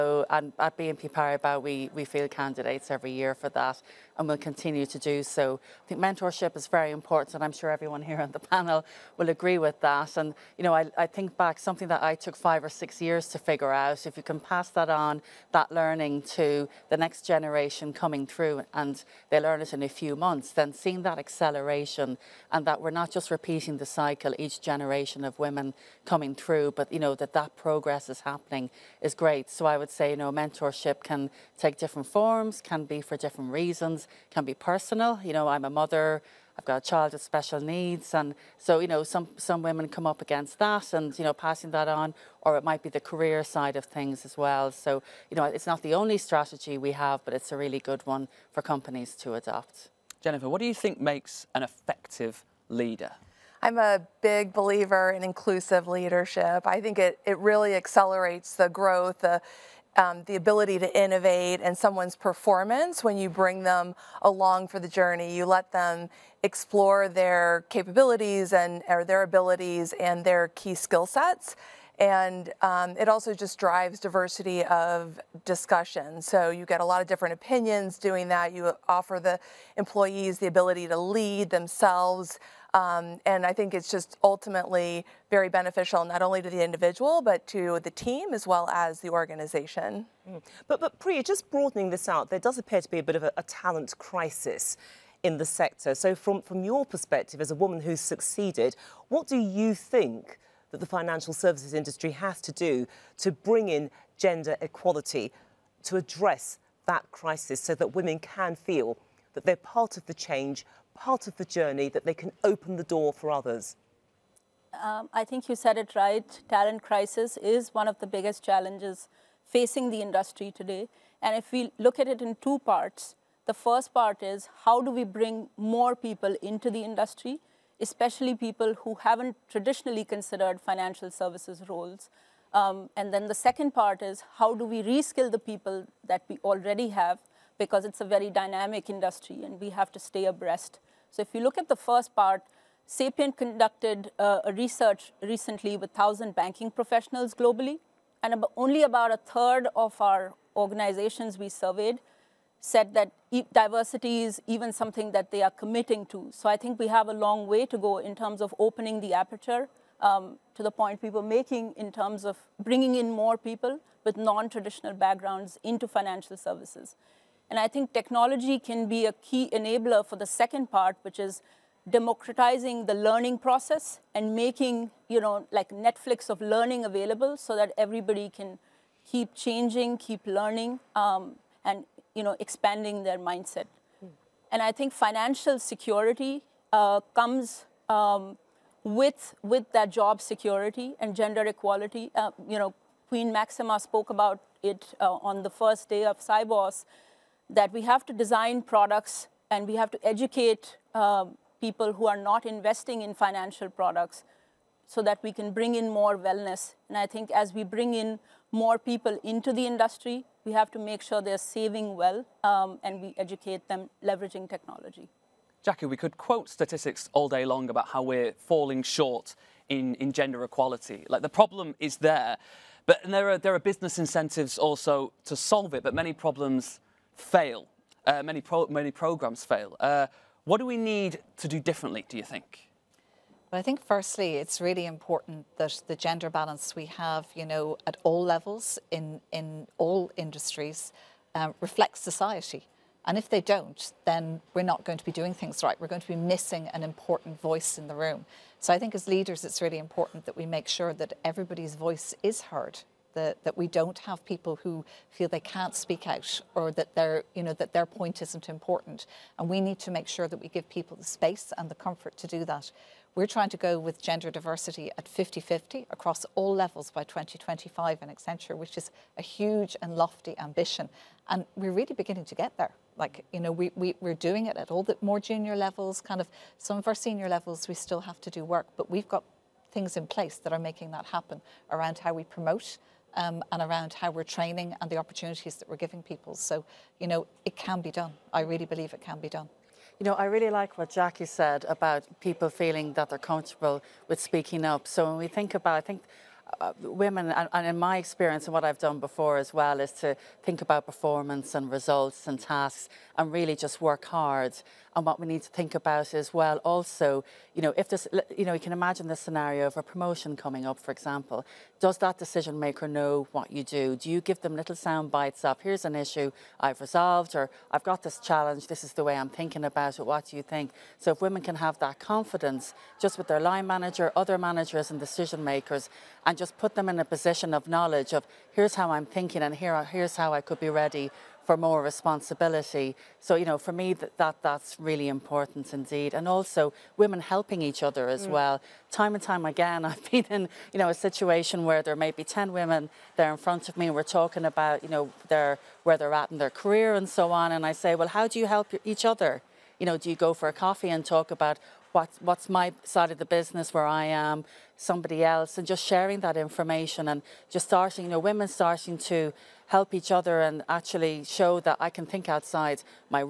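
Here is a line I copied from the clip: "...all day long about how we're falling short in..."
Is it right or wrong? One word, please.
right.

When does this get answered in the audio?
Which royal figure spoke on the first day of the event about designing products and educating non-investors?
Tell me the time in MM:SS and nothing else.
03:13.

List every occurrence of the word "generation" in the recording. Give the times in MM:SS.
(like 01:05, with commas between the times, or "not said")
00:17, 00:24.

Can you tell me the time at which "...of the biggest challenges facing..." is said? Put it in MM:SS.
01:57.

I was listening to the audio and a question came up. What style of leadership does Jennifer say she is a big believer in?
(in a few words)
Inclusive leadership.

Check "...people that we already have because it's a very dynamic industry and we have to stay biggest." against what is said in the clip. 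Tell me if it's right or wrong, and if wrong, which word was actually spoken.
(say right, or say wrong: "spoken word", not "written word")
wrong: "abreast", not "biggest".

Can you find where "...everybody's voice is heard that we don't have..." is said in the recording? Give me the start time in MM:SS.
04:11.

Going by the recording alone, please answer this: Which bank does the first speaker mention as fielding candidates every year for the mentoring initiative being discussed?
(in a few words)
BNP Paribas.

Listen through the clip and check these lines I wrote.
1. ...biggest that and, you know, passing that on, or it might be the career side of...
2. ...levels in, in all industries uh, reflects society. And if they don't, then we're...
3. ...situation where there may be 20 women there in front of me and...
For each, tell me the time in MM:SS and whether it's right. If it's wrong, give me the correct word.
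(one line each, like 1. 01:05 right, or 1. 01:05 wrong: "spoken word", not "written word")
1. 00:40 wrong: "against", not "biggest"
2. 03:58 right
3. 05:40 wrong: "10", not "20".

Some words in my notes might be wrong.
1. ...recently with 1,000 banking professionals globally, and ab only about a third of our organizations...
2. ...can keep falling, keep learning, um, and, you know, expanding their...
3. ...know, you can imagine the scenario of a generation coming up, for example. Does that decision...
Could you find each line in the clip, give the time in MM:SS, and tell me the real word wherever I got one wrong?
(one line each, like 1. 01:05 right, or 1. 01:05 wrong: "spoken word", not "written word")
1. 02:25 right
2. 02:58 wrong: "changing", not "falling"
3. 05:08 wrong: "promotion", not "generation".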